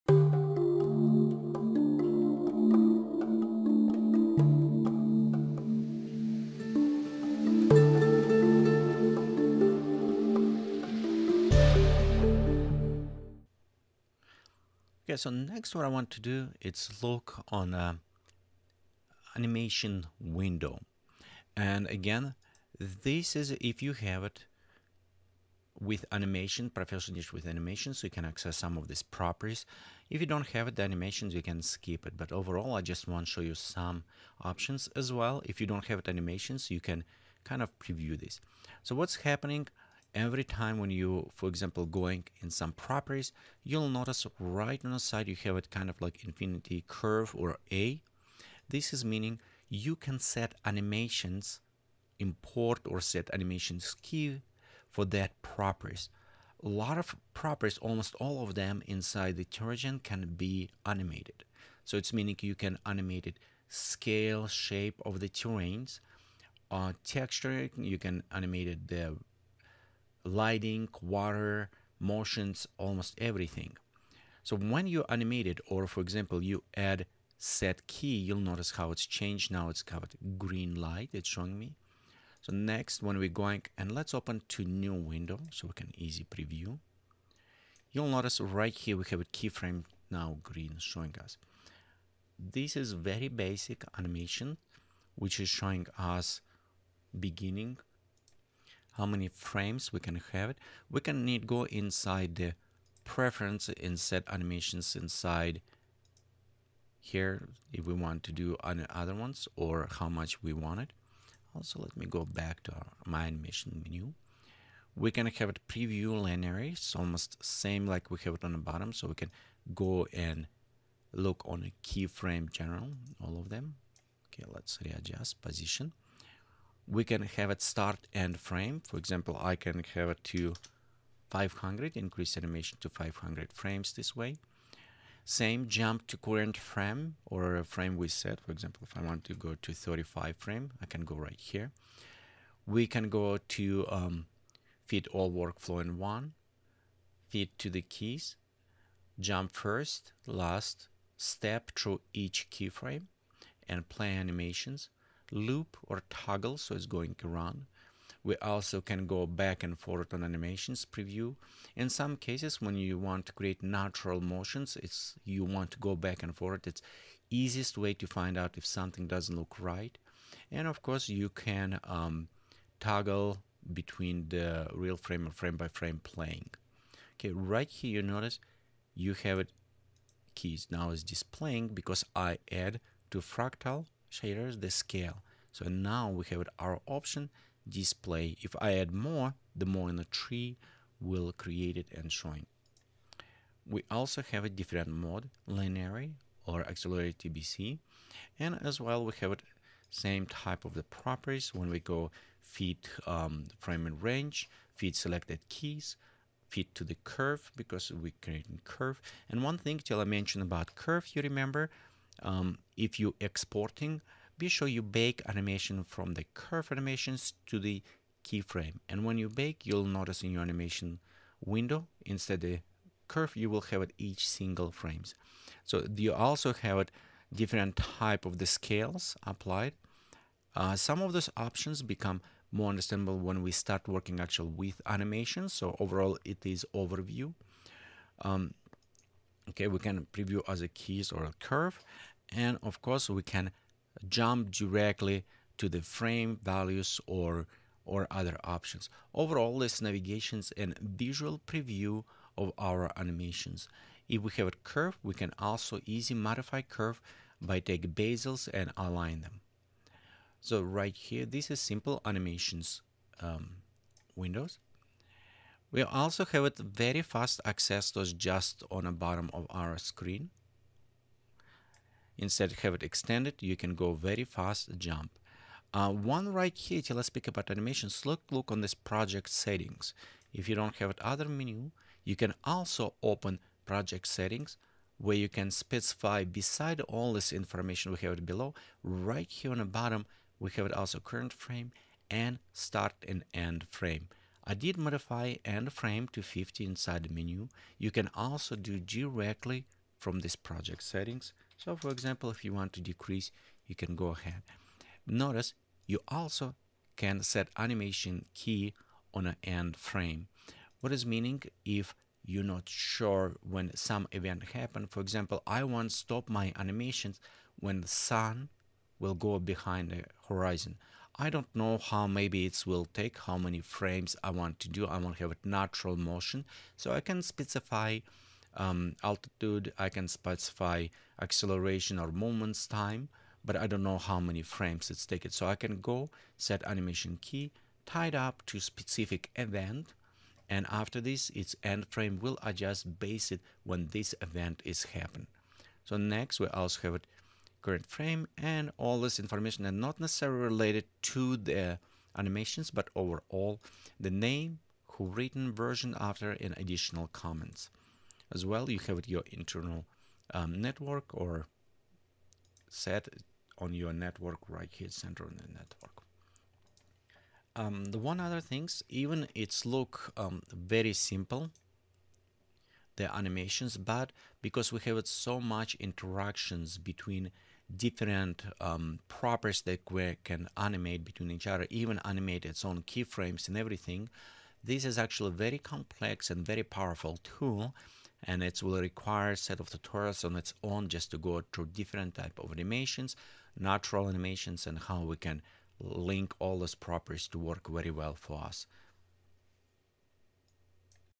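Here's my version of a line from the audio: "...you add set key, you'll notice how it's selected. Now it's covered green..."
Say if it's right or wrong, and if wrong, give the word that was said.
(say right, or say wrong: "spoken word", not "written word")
wrong: "changed", not "selected".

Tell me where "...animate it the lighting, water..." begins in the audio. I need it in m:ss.
1:08.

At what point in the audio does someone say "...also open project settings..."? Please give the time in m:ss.
4:42.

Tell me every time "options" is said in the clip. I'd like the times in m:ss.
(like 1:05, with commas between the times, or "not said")
0:34, 3:06, 3:51, 4:08.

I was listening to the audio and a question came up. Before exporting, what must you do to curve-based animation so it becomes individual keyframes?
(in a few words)
Bake animation.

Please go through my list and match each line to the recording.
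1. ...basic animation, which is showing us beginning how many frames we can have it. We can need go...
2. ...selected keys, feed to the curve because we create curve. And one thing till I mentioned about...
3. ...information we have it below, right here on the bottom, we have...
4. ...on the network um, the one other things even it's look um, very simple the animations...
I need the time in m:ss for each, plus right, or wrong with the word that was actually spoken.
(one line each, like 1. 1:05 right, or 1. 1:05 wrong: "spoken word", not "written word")
1. 1:33 right
2. 3:24 right
3. 4:47 right
4. 6:05 right.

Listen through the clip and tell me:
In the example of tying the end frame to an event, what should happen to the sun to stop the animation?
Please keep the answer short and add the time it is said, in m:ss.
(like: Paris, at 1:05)
Go behind the horizon, at 5:19.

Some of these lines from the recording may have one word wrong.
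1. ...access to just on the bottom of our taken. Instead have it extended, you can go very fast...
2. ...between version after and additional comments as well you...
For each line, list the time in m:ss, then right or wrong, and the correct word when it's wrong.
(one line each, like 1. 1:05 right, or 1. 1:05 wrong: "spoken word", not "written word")
1. 4:27 wrong: "screen", not "taken"
2. 5:55 wrong: "written", not "between".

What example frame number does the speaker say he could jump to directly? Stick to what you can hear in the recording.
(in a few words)
35.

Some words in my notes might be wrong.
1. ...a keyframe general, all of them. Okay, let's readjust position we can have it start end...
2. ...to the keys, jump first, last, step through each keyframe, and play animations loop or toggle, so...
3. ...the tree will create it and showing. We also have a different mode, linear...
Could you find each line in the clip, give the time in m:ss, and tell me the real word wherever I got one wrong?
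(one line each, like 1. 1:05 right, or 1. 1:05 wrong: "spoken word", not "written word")
1. 2:01 right
2. 2:27 right
3. 3:09 right.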